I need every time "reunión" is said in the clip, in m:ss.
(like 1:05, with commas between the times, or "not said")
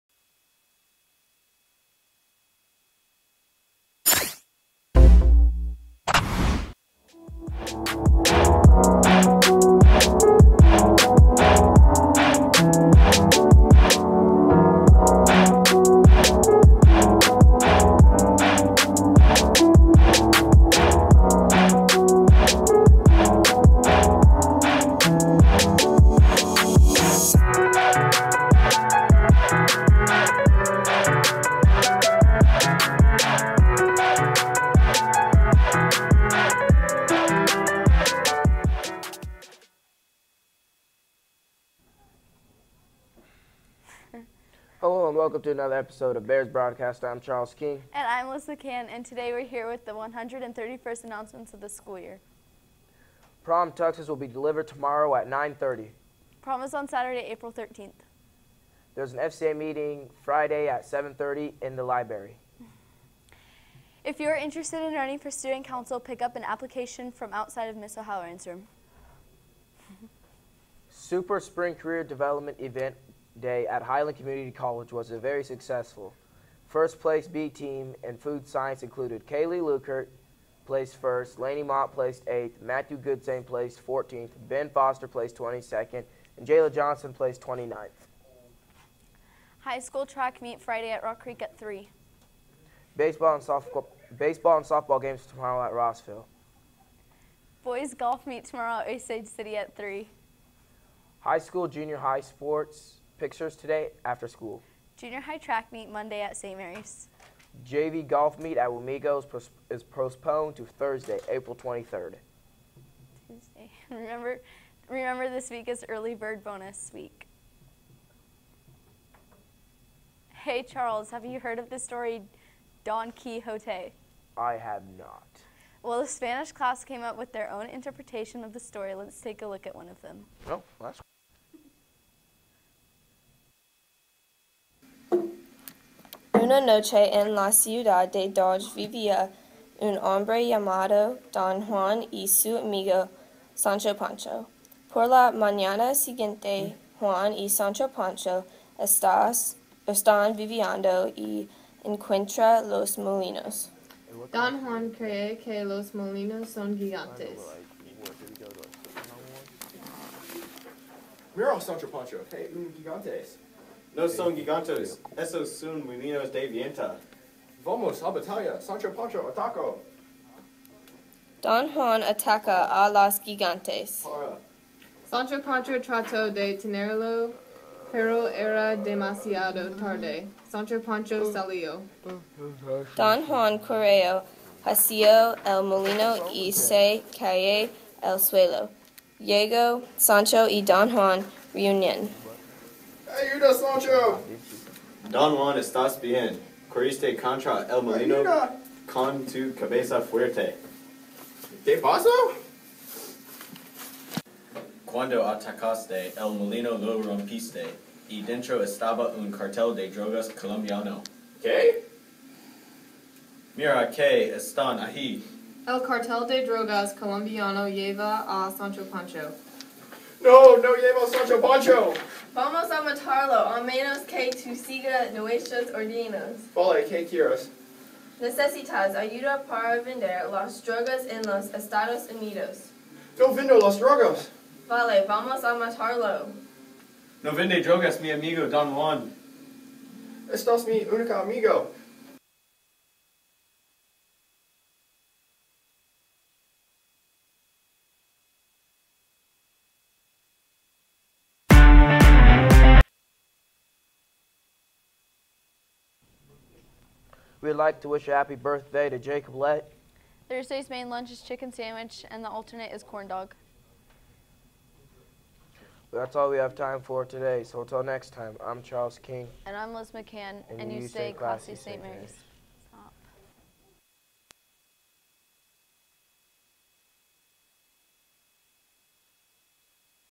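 3:11.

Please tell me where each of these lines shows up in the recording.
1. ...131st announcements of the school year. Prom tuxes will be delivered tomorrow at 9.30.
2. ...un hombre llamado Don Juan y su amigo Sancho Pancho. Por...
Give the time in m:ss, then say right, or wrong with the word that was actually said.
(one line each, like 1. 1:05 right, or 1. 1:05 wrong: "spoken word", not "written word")
1. 0:49 right
2. 2:19 right.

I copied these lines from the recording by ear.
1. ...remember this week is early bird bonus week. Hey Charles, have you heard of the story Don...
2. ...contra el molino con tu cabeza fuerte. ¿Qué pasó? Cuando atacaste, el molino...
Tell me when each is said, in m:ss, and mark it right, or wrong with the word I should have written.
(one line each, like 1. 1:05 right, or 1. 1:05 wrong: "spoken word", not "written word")
1. 1:54 right
2. 3:17 right.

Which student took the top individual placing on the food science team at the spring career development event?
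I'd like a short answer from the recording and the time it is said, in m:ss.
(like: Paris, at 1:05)
Kaylee Lukert, at 1:19.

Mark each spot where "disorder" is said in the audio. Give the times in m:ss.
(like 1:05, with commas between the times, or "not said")
not said.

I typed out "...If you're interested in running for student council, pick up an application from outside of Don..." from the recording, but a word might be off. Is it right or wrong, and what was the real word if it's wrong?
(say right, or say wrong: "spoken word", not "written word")
wrong: "Miss", not "Don".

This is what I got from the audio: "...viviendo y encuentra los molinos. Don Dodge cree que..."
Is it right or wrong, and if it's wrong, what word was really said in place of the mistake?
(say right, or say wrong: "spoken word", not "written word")
wrong: "Juan", not "Dodge".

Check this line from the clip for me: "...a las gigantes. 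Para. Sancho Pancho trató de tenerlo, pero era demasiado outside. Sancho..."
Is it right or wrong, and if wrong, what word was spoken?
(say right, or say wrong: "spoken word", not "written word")
wrong: "tarde", not "outside".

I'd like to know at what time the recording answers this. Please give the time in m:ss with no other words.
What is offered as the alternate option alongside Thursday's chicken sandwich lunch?
4:22.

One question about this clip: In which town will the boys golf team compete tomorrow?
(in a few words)
Osage City.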